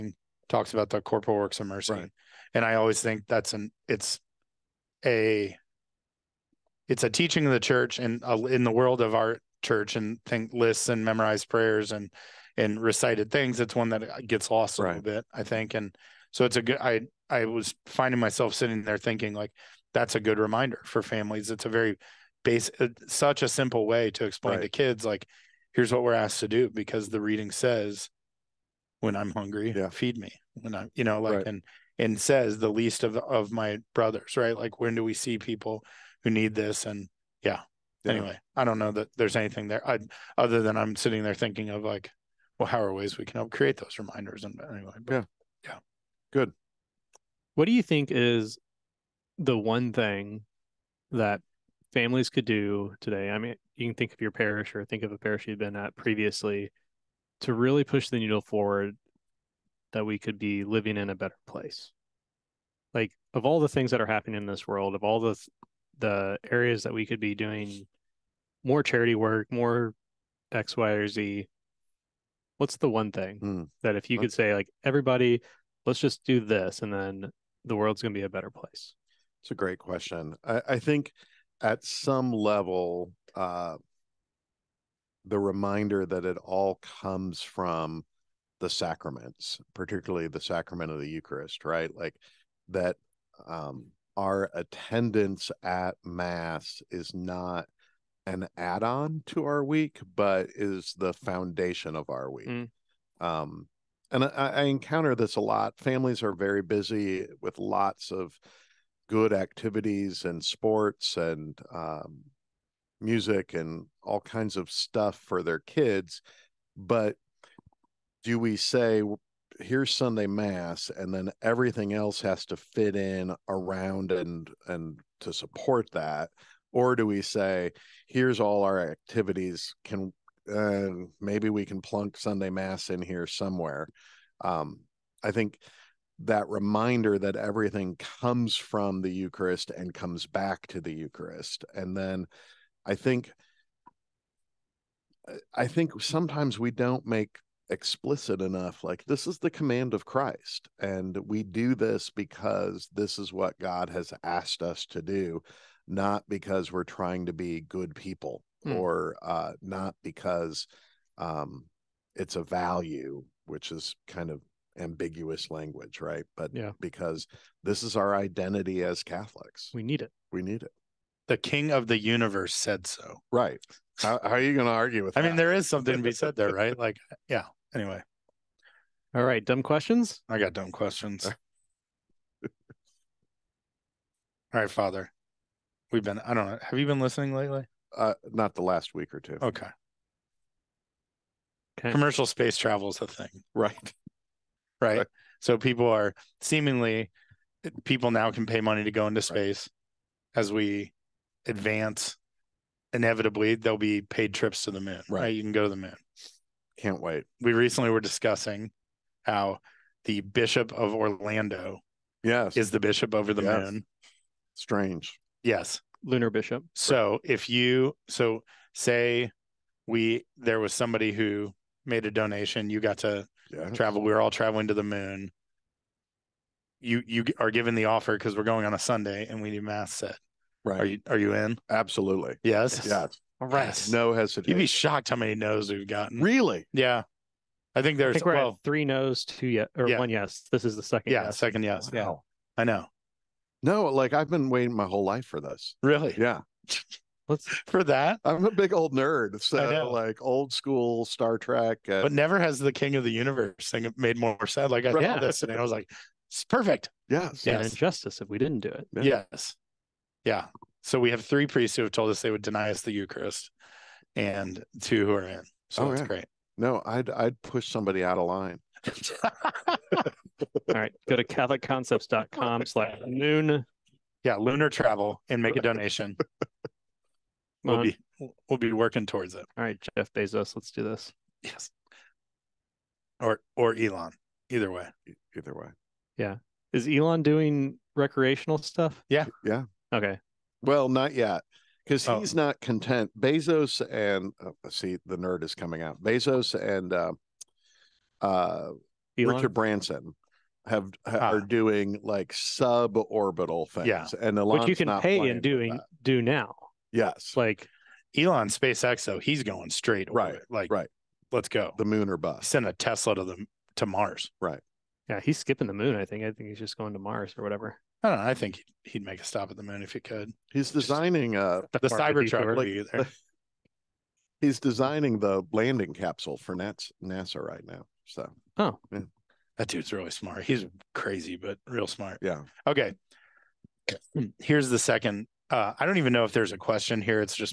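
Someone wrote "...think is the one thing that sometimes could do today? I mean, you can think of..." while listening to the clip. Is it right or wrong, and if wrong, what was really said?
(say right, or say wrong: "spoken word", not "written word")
wrong: "families", not "sometimes".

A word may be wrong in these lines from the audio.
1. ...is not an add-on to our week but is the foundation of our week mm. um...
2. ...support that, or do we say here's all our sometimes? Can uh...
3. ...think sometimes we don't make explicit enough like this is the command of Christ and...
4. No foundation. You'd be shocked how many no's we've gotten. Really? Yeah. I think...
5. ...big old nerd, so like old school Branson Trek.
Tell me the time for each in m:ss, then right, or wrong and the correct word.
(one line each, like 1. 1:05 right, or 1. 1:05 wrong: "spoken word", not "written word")
1. 1:36 right
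2. 2:05 wrong: "activities", not "sometimes"
3. 2:25 right
4. 3:53 wrong: "hesitation", not "foundation"
5. 4:08 wrong: "Star", not "Branson".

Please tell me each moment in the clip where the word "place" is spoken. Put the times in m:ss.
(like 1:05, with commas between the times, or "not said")
1:01, 1:18.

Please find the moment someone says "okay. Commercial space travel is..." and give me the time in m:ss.
3:11.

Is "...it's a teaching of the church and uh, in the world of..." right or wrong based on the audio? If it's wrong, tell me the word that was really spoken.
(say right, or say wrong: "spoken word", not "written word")
right.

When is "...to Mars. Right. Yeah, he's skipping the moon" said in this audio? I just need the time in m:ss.
5:13.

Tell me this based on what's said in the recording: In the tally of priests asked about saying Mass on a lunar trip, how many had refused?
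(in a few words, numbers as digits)
3.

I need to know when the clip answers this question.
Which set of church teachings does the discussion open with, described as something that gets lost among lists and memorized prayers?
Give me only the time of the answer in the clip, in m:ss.
0:00.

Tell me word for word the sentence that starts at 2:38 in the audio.
or uh, not because um, it's a value which is kind of ambiguous language right but yeah.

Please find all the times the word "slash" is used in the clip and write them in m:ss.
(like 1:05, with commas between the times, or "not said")
4:32.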